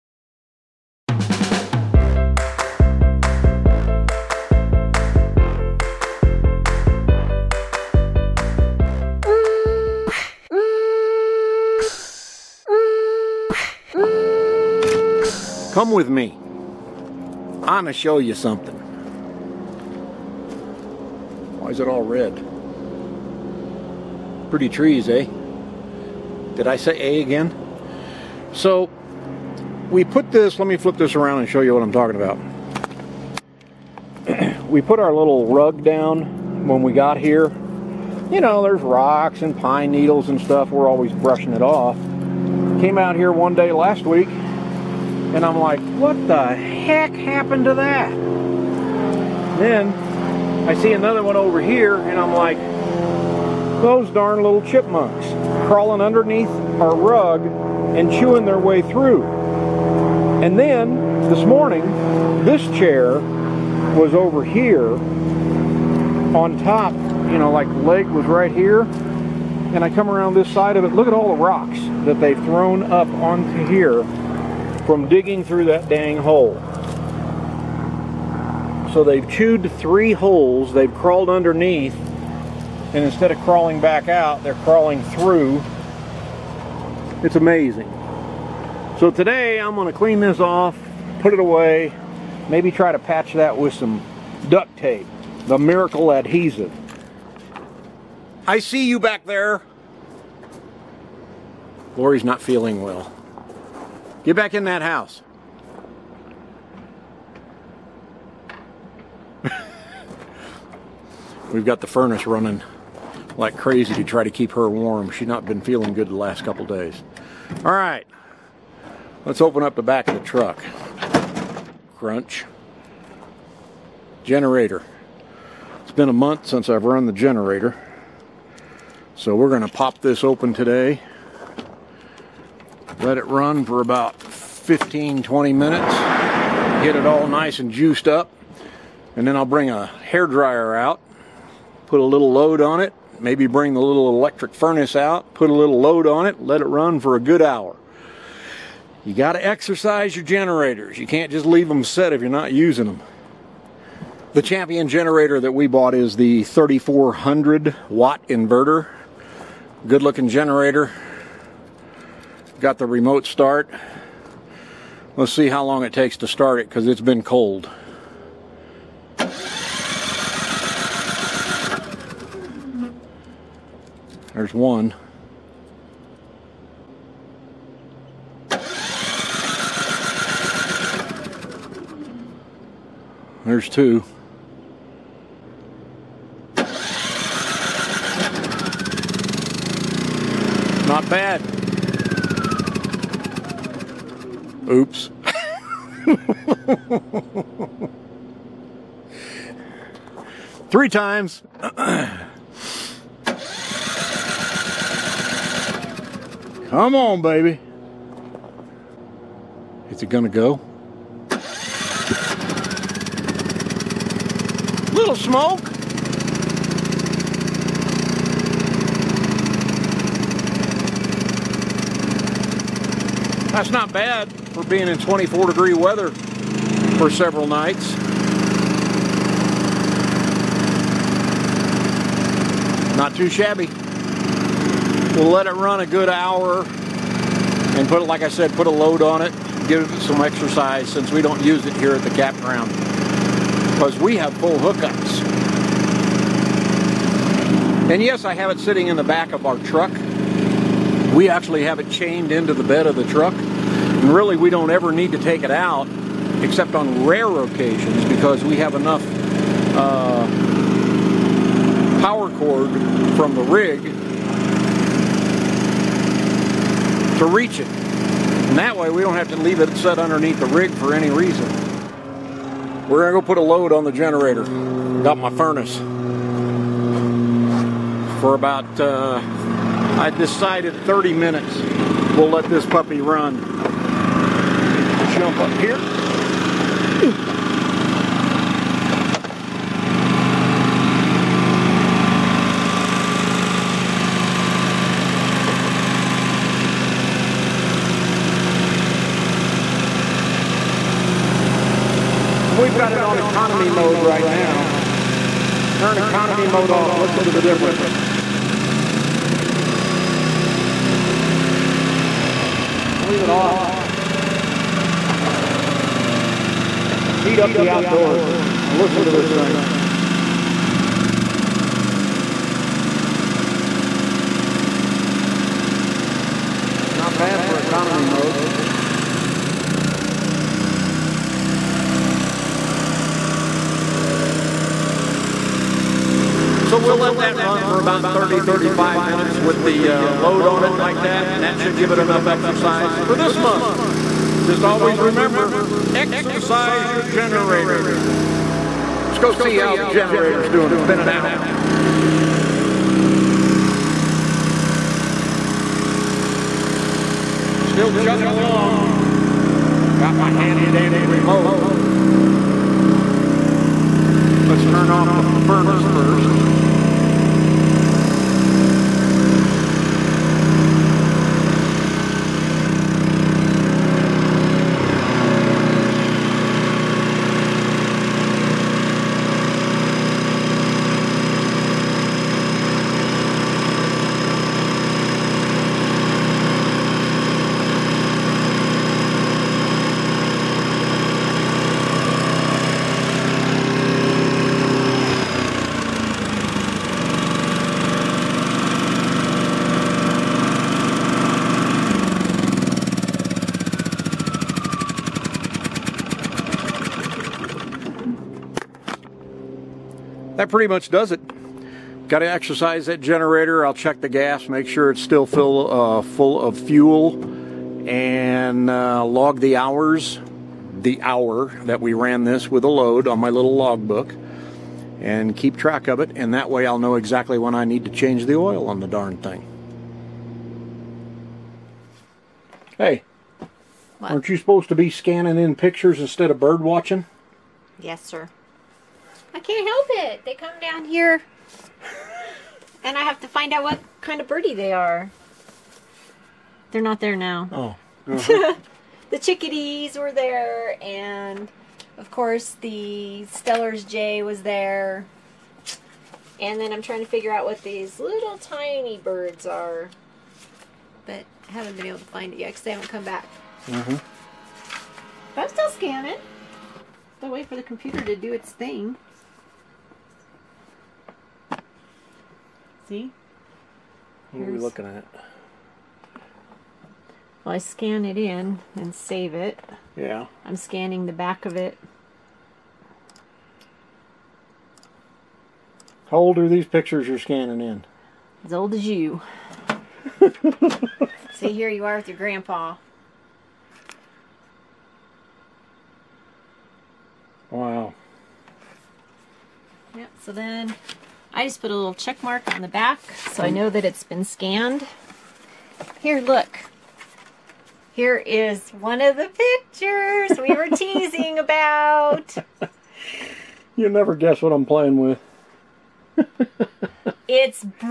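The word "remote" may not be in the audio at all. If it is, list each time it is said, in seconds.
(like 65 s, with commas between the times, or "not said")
162 s, 360 s.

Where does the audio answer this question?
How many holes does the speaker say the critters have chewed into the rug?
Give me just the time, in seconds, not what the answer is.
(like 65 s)
79 s.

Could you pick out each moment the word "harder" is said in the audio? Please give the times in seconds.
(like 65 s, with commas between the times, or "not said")
not said.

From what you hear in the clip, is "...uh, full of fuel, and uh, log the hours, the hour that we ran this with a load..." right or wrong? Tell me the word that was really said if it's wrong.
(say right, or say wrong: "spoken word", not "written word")
right.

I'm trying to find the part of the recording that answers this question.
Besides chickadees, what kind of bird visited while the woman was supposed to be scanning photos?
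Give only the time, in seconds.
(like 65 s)
453 s.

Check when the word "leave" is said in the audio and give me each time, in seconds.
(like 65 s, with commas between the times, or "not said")
151 s, 269 s, 313 s.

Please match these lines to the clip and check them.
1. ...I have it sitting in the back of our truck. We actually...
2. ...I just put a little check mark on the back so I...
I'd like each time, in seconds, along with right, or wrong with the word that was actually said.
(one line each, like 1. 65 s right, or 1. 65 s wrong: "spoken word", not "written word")
1. 248 s right
2. 501 s right.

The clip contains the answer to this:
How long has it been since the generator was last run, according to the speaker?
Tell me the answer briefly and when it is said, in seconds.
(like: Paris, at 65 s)
A month, at 126 s.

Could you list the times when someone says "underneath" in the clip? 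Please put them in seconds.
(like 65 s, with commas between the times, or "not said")
55 s, 81 s, 269 s.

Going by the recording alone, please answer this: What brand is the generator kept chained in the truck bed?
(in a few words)
Champion.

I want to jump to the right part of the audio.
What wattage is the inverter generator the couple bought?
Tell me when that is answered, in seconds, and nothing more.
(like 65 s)
156 s.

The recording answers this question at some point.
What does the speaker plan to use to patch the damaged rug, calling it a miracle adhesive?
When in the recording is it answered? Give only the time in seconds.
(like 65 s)
94 s.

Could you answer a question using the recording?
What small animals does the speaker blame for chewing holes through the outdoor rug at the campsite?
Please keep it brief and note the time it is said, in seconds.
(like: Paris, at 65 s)
Chipmunks, at 54 s.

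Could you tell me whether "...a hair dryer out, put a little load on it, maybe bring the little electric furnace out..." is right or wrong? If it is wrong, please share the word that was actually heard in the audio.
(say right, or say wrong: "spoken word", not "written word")
right.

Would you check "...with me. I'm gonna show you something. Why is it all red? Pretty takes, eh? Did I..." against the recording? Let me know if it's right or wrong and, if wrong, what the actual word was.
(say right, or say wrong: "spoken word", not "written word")
wrong: "trees", not "takes".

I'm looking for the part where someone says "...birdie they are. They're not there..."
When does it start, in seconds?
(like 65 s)
444 s.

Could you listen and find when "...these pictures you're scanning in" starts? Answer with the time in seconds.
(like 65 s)
486 s.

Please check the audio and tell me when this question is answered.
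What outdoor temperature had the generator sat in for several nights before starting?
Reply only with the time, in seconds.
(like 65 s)
224 s.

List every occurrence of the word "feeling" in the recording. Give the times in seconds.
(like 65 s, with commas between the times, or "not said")
102 s, 115 s.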